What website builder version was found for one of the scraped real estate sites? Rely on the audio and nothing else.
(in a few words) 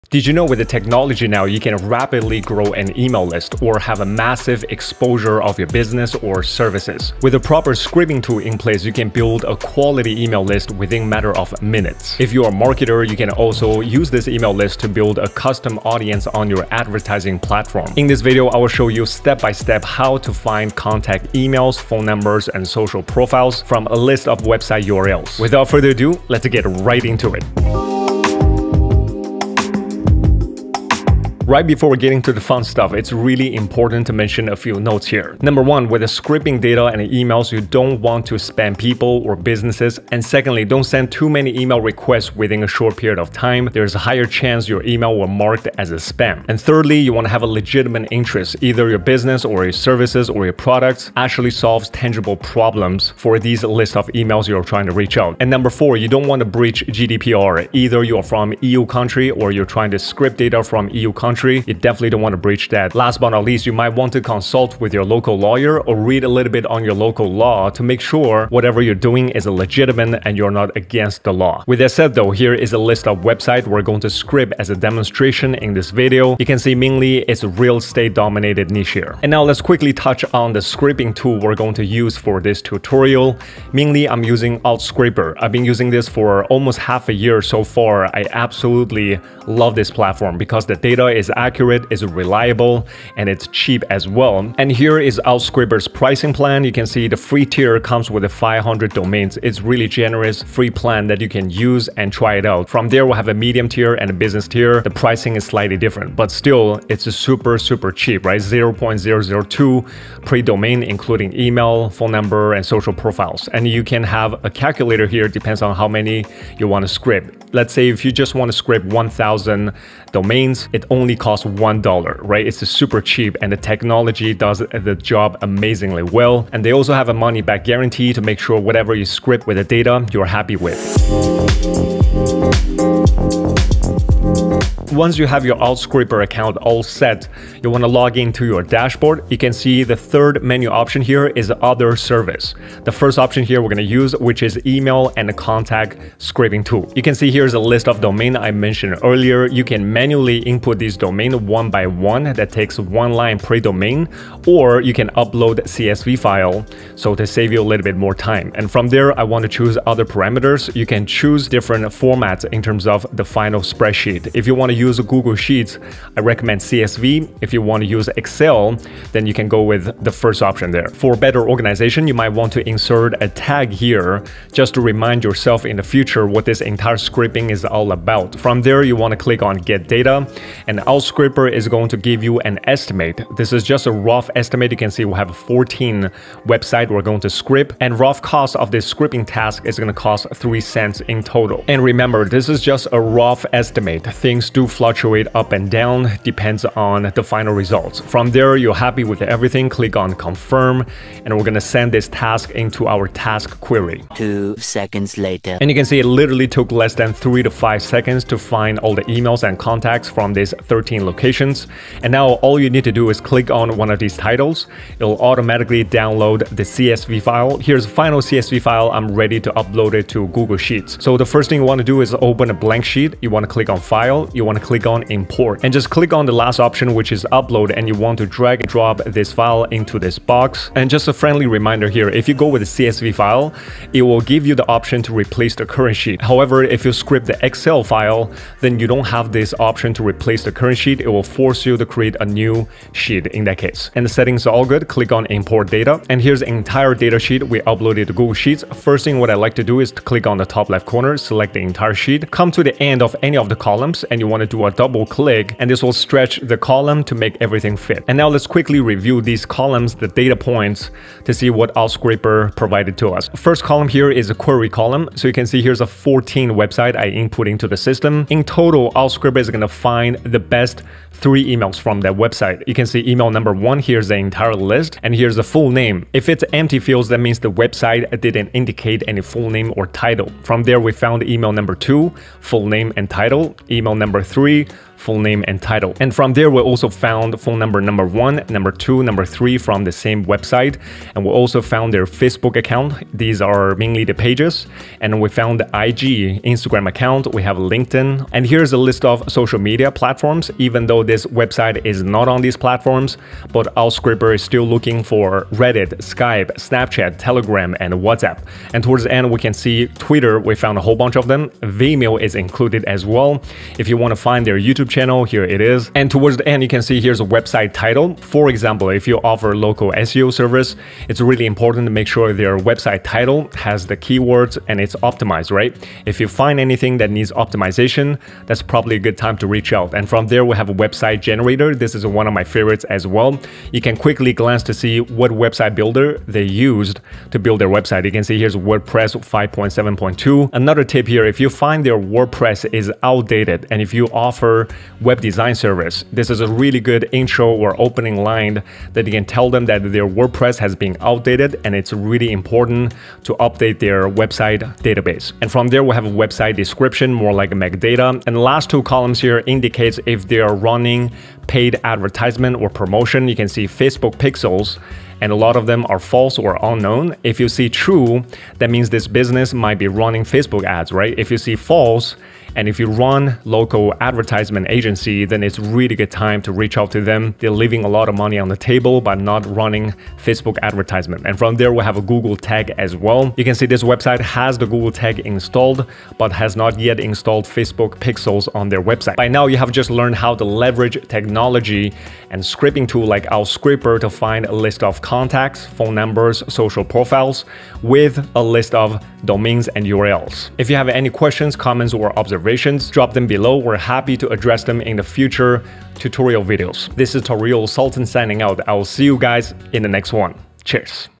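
WordPress 5.7.2.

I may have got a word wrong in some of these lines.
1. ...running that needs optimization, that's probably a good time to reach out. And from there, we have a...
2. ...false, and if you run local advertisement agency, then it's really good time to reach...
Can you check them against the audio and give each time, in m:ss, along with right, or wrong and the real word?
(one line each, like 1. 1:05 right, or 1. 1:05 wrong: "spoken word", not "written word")
1. 5:26 wrong: "anything", not "running"
2. 6:11 right.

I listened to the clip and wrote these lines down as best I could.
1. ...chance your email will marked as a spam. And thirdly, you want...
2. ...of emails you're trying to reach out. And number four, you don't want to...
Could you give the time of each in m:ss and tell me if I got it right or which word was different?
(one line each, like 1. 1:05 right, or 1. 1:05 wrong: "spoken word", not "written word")
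1. 0:44 right
2. 0:53 right.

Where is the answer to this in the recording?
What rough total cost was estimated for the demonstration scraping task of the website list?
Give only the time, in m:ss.
3:10.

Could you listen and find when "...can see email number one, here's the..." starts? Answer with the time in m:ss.
4:32.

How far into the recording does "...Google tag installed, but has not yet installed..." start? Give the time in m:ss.
6:24.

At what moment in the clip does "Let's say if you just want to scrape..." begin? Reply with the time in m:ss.
1:57.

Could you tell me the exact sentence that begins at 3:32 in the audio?
And now all you need to do is click on one of these titles.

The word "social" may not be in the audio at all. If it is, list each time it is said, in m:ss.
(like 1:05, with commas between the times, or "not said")
0:22, 1:52, 4:59, 6:36.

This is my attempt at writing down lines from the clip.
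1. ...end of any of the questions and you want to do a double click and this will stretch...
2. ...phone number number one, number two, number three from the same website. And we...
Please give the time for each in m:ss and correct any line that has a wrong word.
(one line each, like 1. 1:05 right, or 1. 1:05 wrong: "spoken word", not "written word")
1. 4:12 wrong: "columns", not "questions"
2. 4:47 right.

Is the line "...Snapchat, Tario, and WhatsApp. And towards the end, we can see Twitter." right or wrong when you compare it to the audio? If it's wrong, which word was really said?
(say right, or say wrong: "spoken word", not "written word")
wrong: "Telegram", not "Tario".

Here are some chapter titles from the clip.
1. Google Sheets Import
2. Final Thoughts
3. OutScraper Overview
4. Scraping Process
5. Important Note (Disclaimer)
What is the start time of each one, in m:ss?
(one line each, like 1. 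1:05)
1. 3:38
2. 6:28
3. 1:19
4. 2:11
5. 0:27.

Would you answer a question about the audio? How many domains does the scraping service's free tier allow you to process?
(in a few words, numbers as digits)
500.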